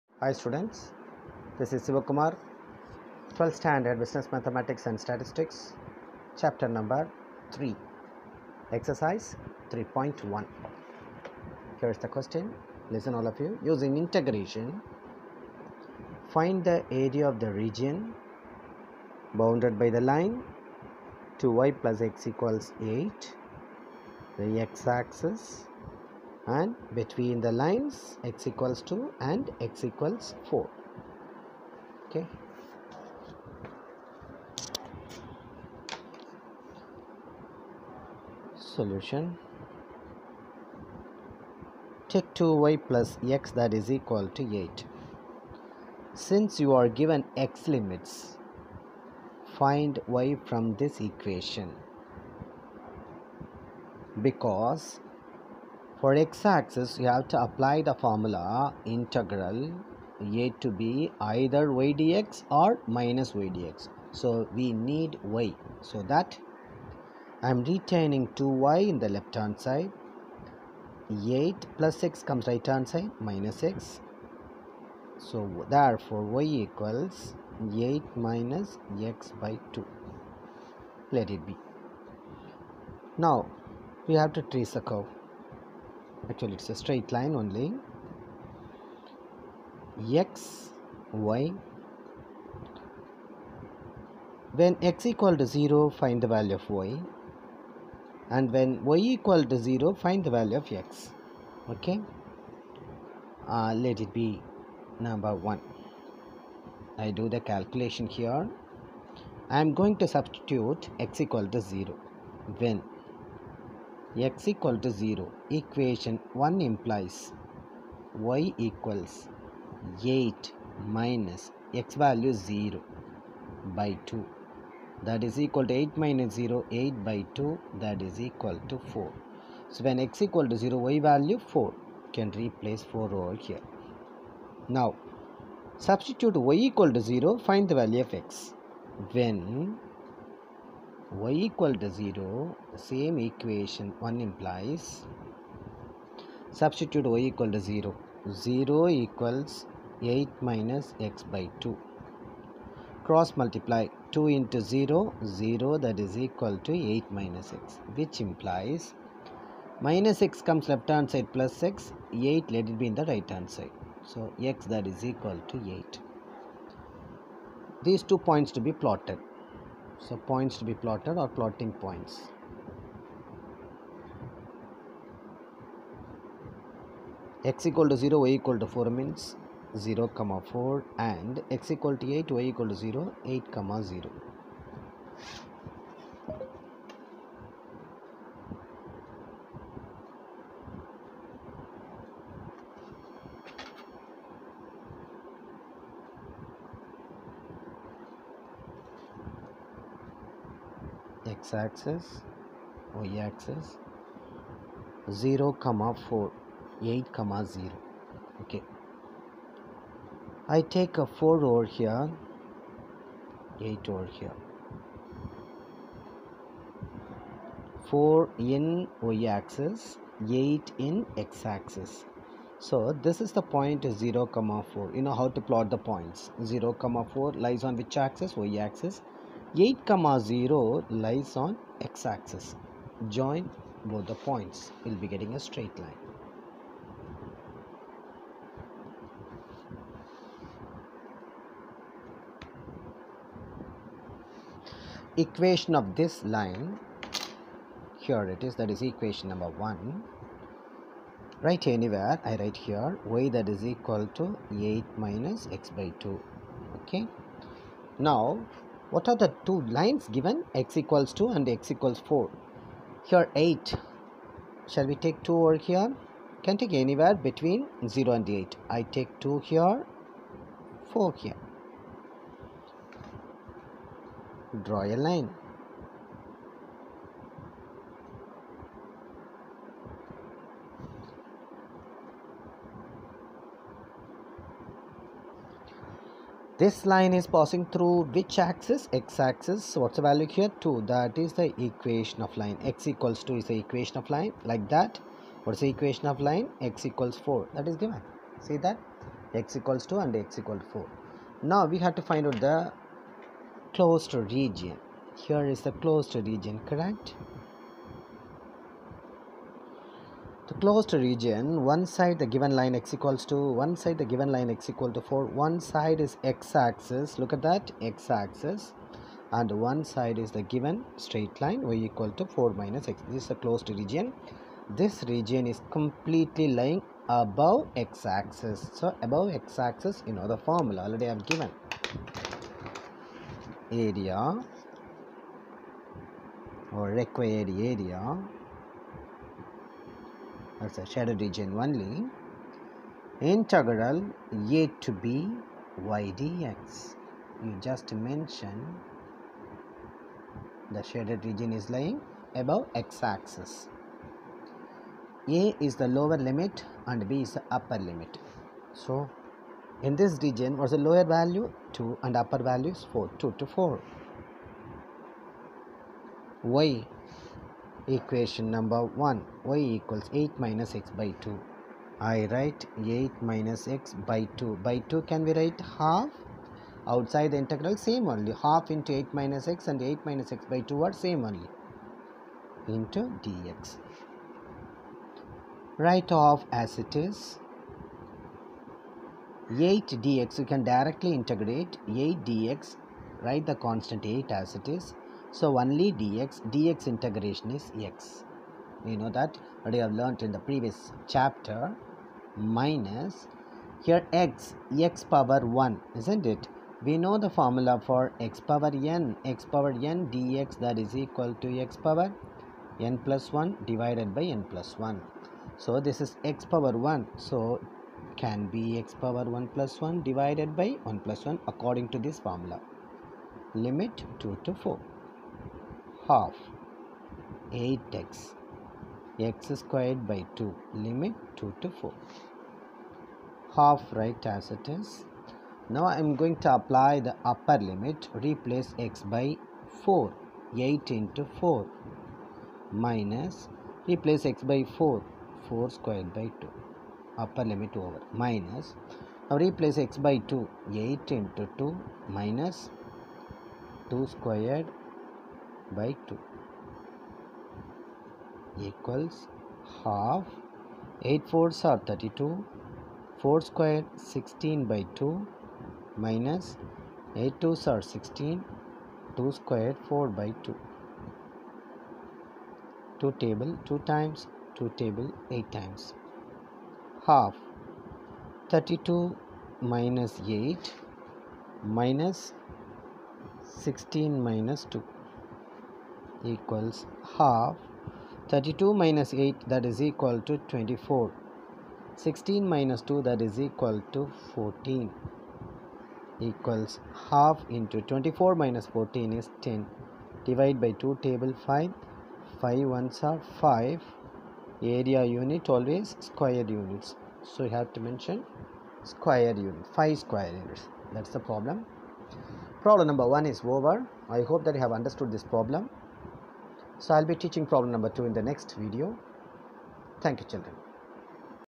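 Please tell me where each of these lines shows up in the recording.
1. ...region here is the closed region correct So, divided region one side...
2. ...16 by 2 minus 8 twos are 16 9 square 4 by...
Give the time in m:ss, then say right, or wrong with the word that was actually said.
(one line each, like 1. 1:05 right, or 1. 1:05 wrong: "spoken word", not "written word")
1. 5:04 wrong: "closed", not "divided"
2. 7:44 wrong: "2", not "9".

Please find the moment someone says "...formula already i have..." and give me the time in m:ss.
5:30.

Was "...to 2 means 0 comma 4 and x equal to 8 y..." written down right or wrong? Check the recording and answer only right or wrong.
wrong.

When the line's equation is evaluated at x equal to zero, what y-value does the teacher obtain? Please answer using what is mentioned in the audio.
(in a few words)
4.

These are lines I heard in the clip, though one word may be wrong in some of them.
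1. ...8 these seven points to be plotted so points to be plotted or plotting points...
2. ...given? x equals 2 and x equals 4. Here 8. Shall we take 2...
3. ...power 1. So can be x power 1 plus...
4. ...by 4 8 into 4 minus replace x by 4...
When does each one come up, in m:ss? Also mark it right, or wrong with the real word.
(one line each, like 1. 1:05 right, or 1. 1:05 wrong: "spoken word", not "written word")
1. 2:45 wrong: "two", not "seven"
2. 4:20 right
3. 6:56 right
4. 7:19 right.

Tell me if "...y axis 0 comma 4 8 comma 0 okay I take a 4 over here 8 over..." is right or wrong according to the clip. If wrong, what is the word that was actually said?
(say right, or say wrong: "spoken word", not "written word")
right.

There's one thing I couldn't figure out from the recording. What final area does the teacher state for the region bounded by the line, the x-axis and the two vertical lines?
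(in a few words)
5 square units.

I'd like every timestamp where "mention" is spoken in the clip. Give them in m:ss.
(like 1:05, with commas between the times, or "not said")
5:48, 8:27.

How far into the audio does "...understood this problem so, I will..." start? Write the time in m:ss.
8:34.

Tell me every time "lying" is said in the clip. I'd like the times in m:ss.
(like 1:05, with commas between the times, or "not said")
5:26, 5:51.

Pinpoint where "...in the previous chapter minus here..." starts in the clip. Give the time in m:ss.
6:40.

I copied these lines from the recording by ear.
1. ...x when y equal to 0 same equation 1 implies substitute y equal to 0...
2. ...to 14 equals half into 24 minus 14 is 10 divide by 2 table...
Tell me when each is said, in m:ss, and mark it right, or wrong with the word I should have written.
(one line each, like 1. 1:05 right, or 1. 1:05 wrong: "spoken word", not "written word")
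1. 2:18 right
2. 8:13 right.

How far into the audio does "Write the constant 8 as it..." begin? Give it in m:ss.
6:33.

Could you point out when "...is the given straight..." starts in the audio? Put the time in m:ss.
5:20.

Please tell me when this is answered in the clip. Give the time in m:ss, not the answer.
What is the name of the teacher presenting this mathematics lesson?
0:01.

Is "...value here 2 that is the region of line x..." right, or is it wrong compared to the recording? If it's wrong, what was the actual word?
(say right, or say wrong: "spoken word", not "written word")
wrong: "equation", not "region".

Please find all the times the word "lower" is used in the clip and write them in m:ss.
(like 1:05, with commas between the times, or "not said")
5:55, 6:00.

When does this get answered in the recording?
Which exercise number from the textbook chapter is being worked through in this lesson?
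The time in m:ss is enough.
0:08.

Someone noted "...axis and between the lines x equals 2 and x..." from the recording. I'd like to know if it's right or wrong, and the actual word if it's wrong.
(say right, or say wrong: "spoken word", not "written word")
right.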